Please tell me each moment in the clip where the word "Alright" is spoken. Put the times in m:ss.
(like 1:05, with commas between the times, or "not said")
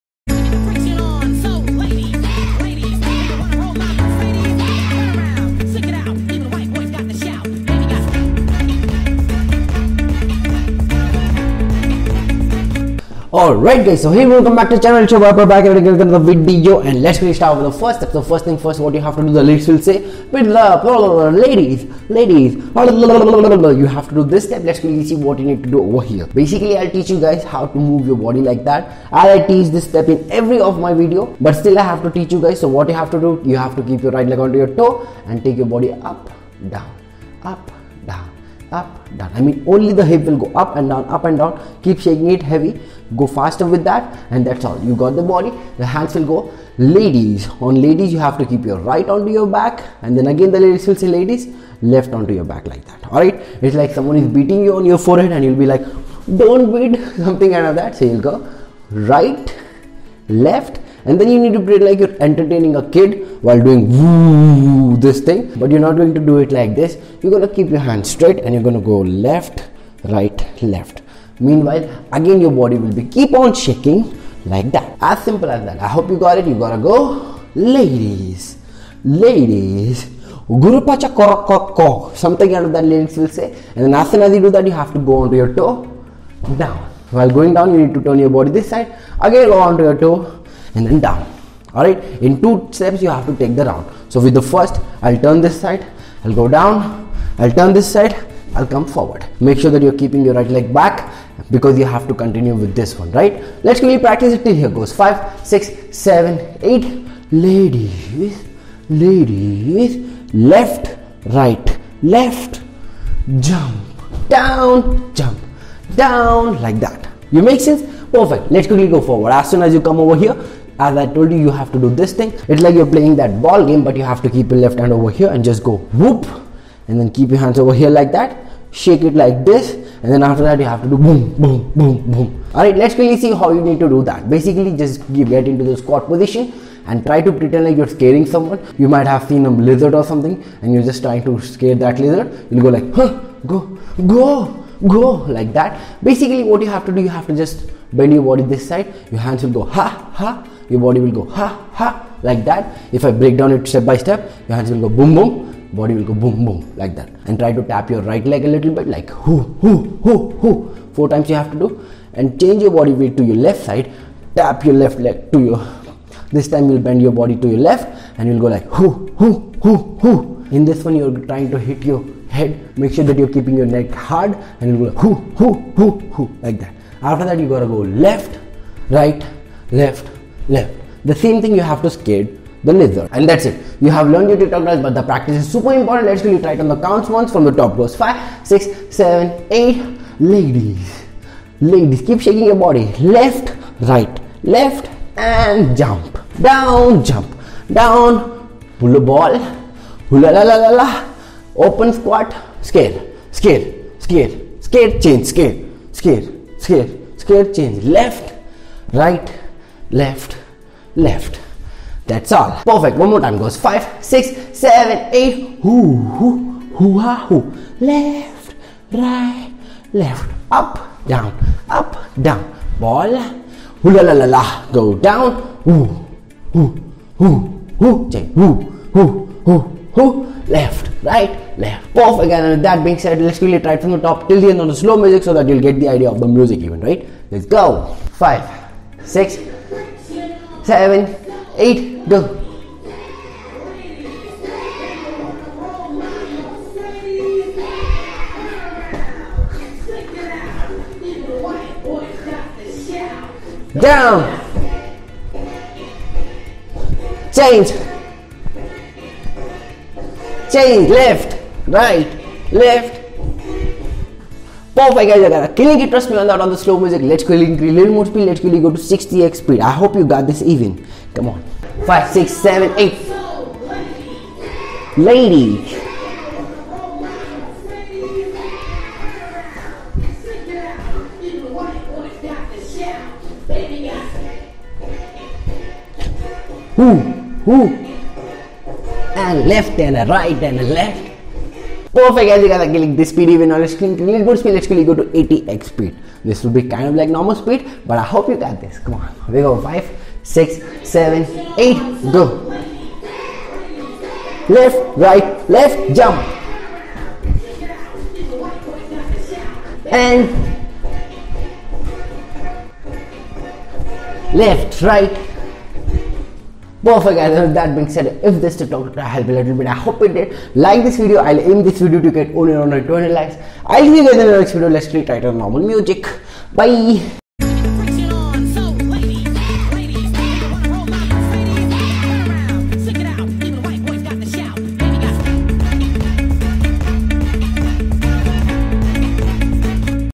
0:13.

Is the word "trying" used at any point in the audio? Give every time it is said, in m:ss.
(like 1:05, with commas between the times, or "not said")
2:21, 2:51.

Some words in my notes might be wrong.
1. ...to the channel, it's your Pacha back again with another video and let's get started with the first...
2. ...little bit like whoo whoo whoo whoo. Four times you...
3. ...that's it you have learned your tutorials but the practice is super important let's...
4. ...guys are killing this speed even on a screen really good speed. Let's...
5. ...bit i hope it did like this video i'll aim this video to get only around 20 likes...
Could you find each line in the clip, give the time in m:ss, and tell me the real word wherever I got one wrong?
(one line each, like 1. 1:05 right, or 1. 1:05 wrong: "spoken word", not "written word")
1. 0:14 wrong: "Viper", not "Pacha"
2. 2:38 right
3. 3:03 right
4. 4:52 right
5. 5:19 right.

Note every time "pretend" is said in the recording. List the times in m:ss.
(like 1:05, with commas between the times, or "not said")
1:01, 2:17.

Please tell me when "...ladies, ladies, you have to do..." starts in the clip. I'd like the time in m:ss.
0:21.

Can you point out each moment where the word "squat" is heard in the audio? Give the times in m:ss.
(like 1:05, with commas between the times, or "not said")
2:15, 3:21.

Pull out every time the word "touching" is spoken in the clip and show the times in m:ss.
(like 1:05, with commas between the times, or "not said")
not said.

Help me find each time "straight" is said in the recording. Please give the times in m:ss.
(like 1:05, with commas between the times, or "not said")
1:08.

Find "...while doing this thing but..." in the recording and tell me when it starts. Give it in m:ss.
1:03.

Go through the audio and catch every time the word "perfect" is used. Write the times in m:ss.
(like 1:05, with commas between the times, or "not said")
1:58, 3:32, 4:24, 4:51, 5:16.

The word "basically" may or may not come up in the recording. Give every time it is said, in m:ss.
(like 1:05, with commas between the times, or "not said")
0:26, 2:14, 2:26.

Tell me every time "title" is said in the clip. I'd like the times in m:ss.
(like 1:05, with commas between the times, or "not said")
5:25.